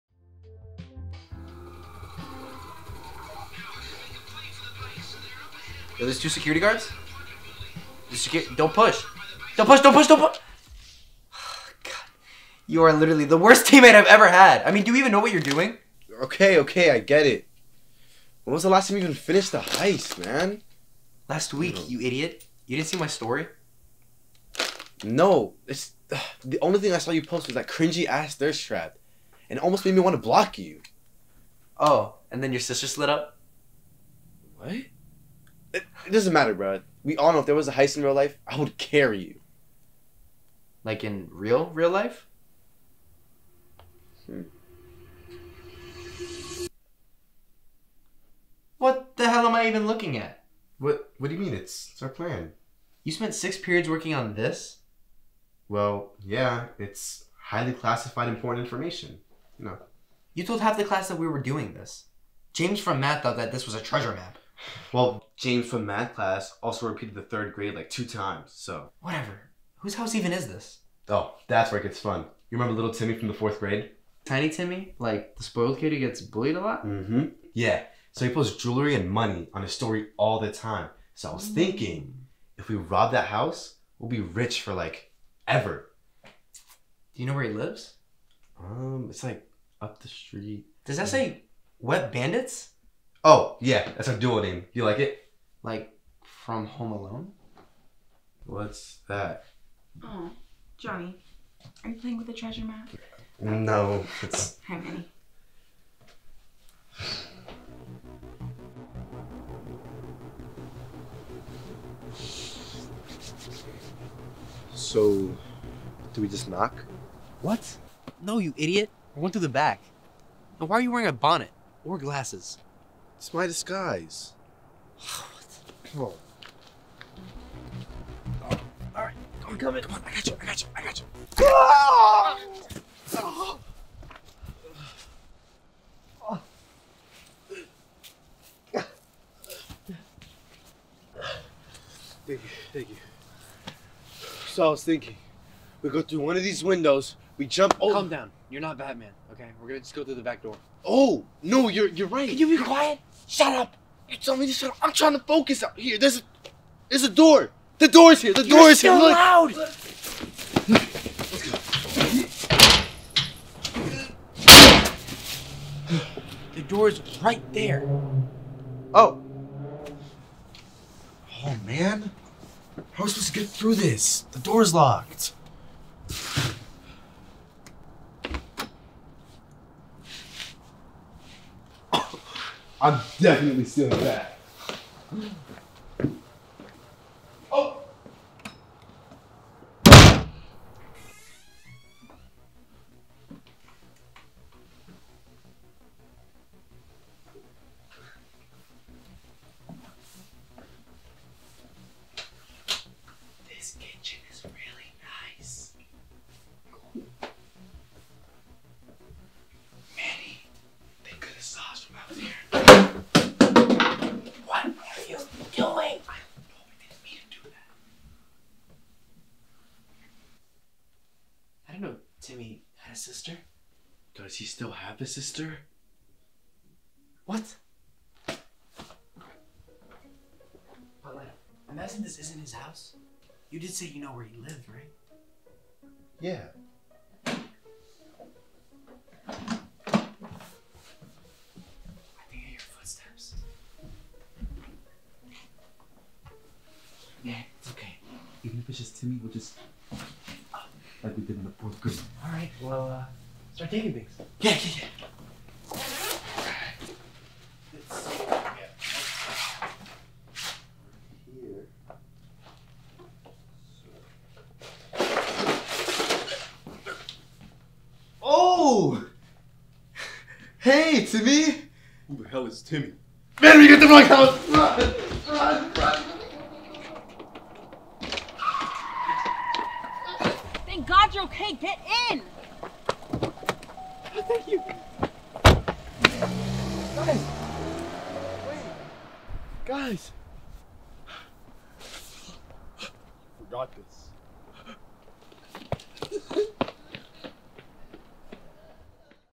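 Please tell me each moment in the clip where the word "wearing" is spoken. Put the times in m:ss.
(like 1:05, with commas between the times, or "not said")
2:00.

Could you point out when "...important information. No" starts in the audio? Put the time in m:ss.
0:58.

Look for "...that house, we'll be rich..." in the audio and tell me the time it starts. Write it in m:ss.
1:23.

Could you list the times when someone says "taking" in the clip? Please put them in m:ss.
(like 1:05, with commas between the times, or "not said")
4:13.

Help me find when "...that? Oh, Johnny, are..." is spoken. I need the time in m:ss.
1:39.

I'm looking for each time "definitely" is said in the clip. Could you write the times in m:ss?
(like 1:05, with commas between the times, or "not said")
3:03.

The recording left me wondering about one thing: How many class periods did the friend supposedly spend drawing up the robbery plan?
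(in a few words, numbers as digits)
6.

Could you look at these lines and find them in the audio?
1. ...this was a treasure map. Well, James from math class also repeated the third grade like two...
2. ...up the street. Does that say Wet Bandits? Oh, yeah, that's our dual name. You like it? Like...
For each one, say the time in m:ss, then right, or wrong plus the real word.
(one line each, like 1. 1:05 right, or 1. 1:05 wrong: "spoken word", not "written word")
1. 1:03 right
2. 1:29 right.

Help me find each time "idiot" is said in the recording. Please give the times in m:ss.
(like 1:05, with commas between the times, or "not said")
0:22, 1:58.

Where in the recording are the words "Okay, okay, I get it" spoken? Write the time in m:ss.
0:16.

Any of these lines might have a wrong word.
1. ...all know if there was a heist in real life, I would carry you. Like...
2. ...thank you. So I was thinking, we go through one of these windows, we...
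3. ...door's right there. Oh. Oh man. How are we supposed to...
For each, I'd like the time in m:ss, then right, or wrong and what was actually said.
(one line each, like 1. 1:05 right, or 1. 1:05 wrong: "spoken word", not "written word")
1. 0:37 right
2. 2:22 right
3. 2:46 right.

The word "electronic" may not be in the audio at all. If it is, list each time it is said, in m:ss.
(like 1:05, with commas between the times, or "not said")
not said.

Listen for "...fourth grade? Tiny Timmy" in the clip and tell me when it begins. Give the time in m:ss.
1:13.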